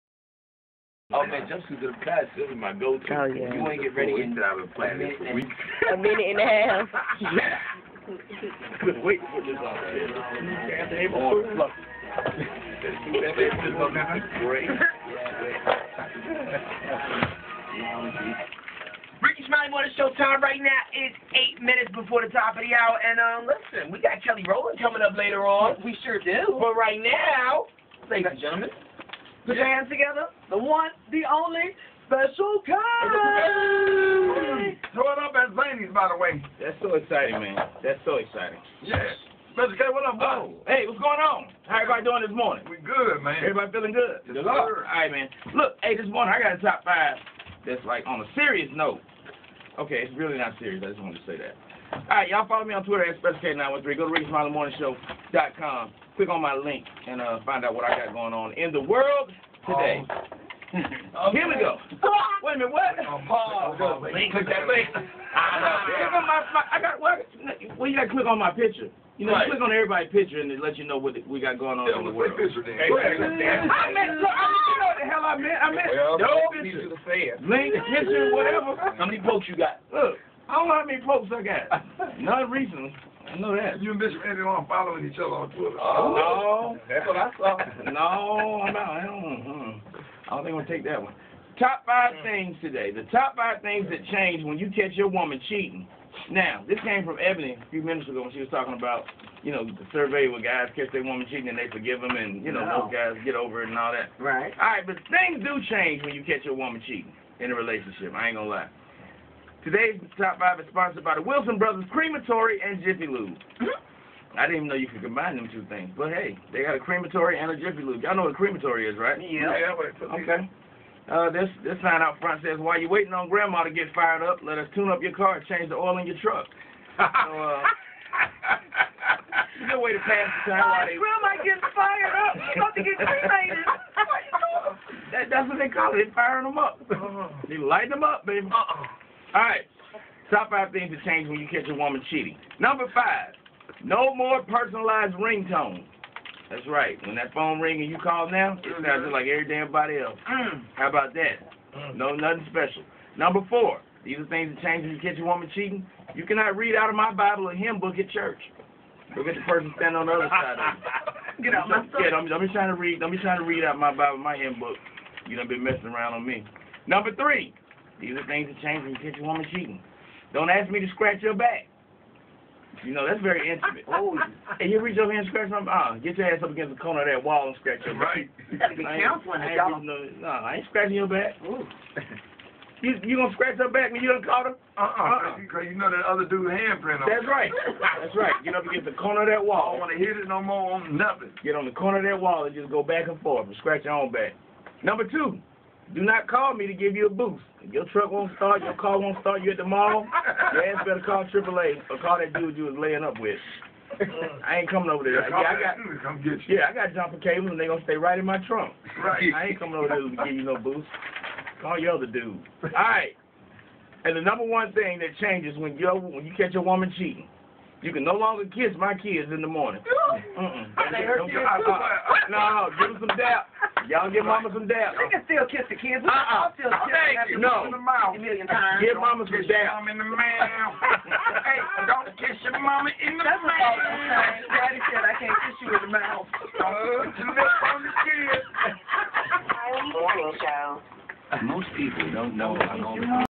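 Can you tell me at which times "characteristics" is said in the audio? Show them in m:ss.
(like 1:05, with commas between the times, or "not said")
not said.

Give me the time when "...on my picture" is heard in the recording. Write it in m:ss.
1:08.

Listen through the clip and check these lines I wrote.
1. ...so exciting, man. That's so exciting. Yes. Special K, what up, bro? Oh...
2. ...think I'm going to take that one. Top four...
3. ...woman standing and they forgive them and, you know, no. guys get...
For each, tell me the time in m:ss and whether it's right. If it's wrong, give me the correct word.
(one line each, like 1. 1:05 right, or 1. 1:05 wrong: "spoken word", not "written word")
1. 0:36 right
2. 1:30 wrong: "five", not "four"
3. 1:41 wrong: "cheating", not "standing".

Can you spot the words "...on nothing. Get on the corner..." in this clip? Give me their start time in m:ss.
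3:10.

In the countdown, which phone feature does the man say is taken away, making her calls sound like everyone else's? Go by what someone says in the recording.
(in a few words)
Personalized ringtone.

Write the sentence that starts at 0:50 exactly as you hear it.
I just wanted to say that.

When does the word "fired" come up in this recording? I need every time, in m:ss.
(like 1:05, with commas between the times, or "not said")
2:03, 2:11.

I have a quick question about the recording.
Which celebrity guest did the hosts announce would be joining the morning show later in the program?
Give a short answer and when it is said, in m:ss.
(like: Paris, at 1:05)
Kelly Rowland, at 0:24.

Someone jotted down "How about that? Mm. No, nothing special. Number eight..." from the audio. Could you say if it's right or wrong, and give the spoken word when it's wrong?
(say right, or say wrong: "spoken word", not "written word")
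wrong: "four", not "eight".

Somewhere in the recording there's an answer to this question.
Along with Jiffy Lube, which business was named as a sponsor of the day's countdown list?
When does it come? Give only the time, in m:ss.
1:51.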